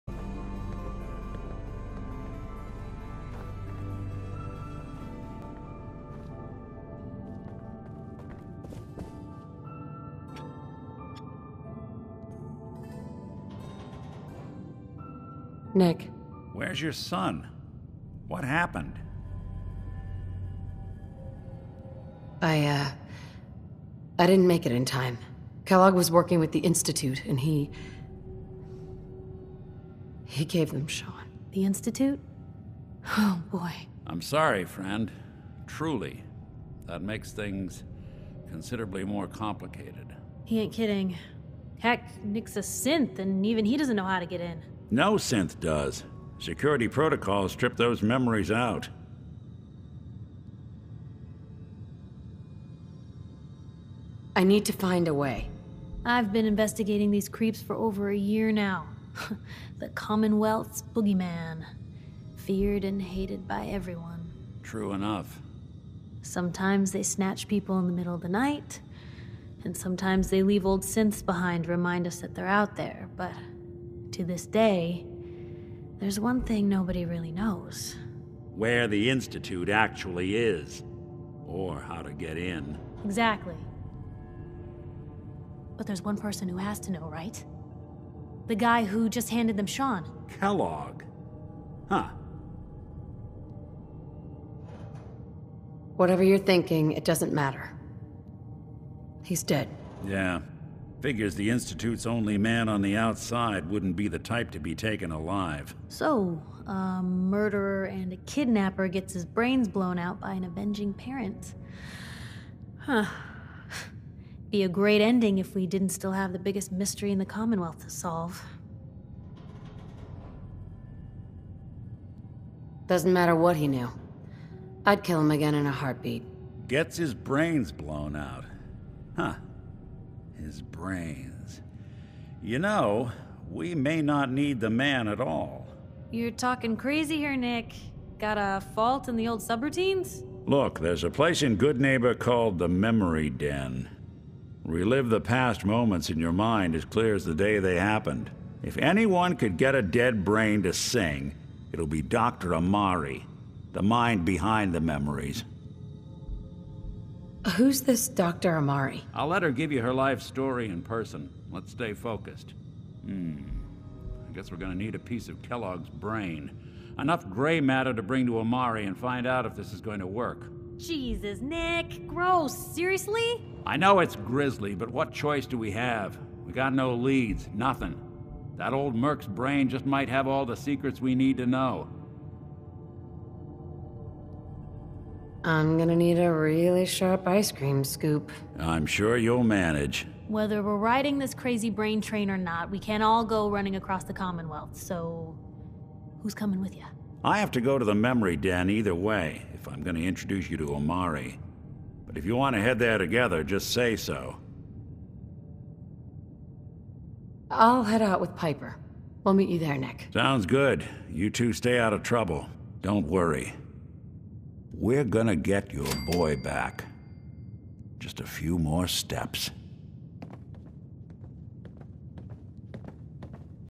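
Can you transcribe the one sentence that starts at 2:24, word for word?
Relive the past moments in your mind as clear as the day they happened.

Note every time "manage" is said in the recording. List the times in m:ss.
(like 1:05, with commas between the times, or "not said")
3:09.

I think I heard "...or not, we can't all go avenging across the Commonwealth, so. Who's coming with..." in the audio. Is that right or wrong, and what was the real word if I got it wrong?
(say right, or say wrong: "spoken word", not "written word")
wrong: "running", not "avenging".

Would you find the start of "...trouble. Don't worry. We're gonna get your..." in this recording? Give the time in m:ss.
3:32.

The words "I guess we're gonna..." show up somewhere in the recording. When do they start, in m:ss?
2:44.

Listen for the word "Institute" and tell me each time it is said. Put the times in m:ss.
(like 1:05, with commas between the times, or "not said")
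0:26, 0:31, 1:19, 1:41.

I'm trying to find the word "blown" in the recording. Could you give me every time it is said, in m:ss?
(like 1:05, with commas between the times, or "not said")
1:49, 2:07.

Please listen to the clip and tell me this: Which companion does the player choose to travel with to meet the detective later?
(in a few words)
Piper.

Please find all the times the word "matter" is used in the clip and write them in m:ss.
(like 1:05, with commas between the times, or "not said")
1:37, 2:03, 2:47.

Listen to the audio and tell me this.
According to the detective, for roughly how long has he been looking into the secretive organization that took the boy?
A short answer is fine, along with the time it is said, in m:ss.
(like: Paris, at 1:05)
over a year, at 0:57.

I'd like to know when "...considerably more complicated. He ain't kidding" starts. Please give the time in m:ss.
0:38.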